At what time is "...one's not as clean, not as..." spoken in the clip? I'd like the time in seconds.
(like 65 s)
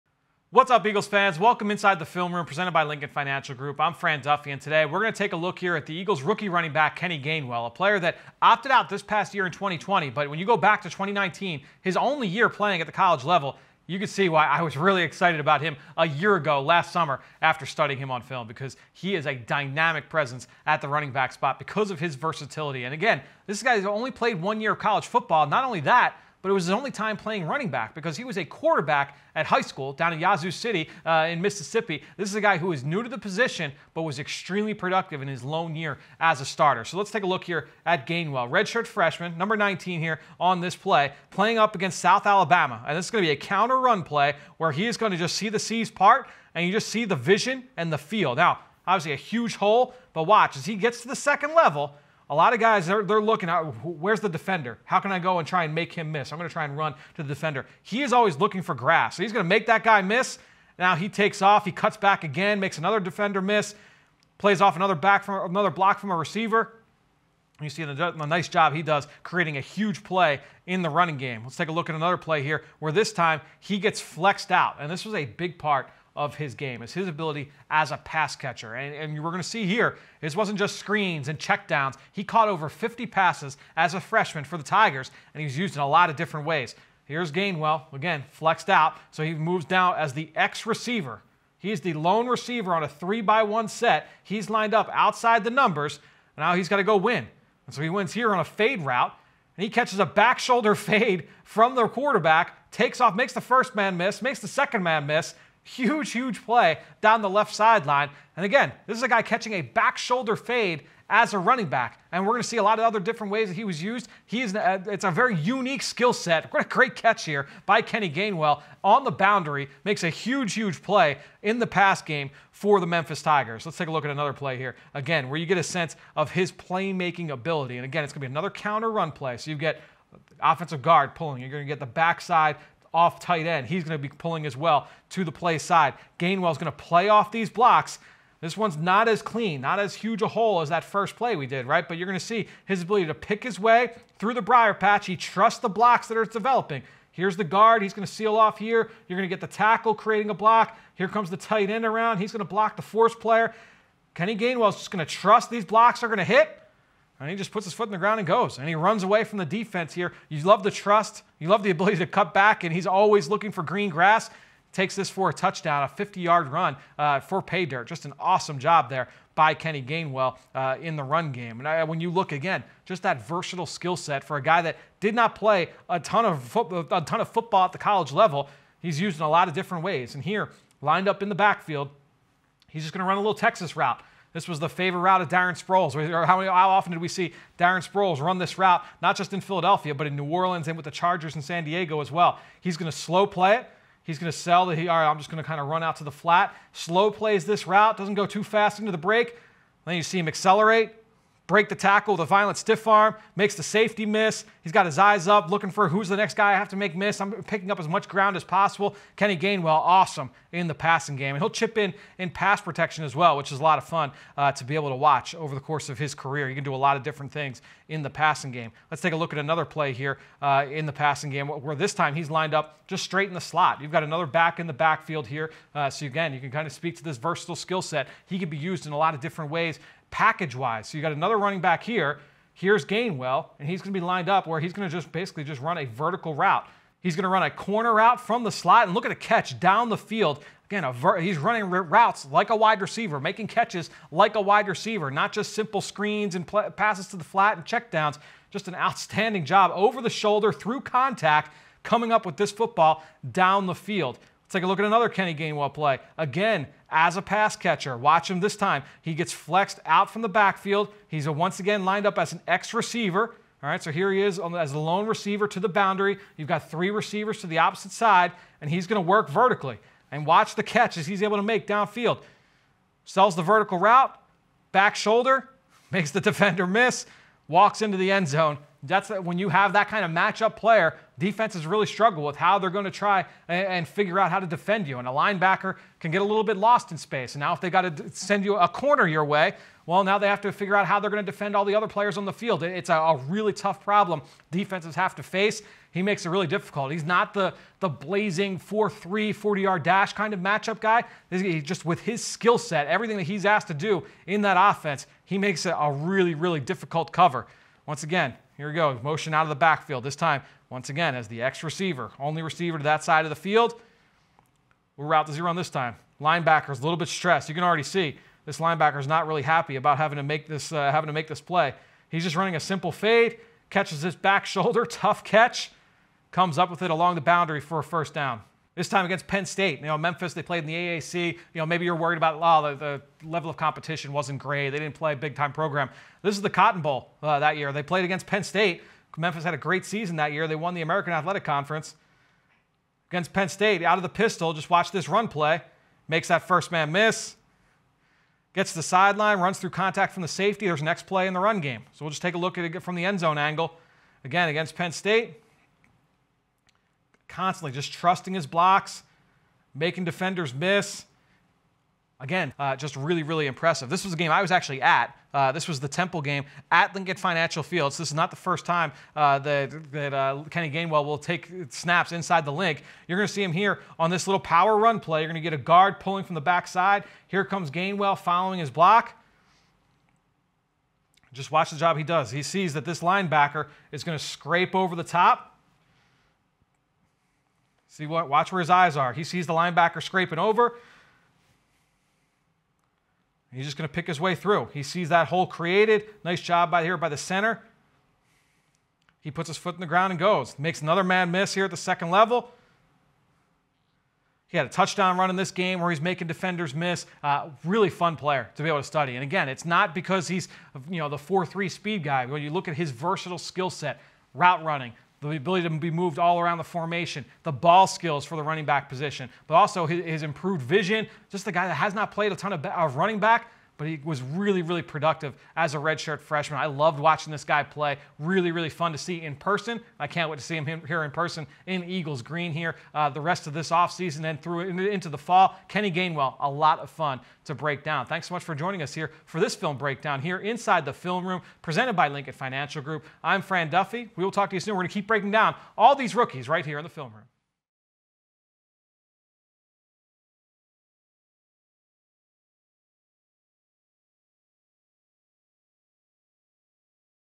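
138 s.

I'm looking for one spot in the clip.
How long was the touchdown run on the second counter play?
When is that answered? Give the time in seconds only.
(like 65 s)
165 s.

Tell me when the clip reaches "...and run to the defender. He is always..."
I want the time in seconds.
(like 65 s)
56 s.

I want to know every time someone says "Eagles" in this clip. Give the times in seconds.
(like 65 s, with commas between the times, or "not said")
0 s, 5 s, 431 s.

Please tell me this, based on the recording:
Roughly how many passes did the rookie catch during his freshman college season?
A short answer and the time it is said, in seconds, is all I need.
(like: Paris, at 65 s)
Over 50, at 82 s.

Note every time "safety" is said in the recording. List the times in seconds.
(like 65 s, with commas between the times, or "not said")
203 s, 350 s.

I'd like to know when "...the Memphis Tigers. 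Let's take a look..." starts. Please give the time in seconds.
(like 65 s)
122 s.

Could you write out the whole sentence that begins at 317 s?
You can already see this linebacker's not really happy about having to make this uh, having to make this play.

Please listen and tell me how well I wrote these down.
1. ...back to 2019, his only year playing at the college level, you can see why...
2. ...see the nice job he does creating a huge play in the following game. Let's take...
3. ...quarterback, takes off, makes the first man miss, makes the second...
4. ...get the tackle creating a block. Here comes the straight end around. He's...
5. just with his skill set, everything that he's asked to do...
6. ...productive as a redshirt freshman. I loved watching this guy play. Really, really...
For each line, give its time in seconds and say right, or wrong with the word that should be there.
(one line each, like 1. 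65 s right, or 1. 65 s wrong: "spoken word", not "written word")
1. 10 s right
2. 67 s wrong: "running", not "following"
3. 101 s right
4. 149 s wrong: "tight", not "straight"
5. 301 s right
6. 424 s right.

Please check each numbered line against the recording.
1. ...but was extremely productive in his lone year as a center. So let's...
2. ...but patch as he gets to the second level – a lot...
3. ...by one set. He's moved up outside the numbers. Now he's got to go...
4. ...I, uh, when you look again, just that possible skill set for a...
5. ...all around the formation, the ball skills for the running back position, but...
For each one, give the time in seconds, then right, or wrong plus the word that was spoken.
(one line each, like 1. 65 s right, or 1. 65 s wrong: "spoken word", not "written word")
1. 33 s wrong: "starter", not "center"
2. 50 s wrong: "watch", not "patch"
3. 93 s wrong: "lined", not "moved"
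4. 171 s wrong: "versatile", not "possible"
5. 416 s right.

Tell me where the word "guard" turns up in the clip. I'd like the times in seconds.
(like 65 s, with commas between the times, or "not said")
130 s, 147 s, 375 s.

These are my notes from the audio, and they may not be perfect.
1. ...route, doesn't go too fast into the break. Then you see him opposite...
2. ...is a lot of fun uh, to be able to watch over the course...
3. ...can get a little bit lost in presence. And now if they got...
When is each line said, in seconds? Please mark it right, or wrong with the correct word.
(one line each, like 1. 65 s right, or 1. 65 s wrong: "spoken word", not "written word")
1. 197 s wrong: "accelerate", not "opposite"
2. 213 s right
3. 285 s wrong: "space", not "presence".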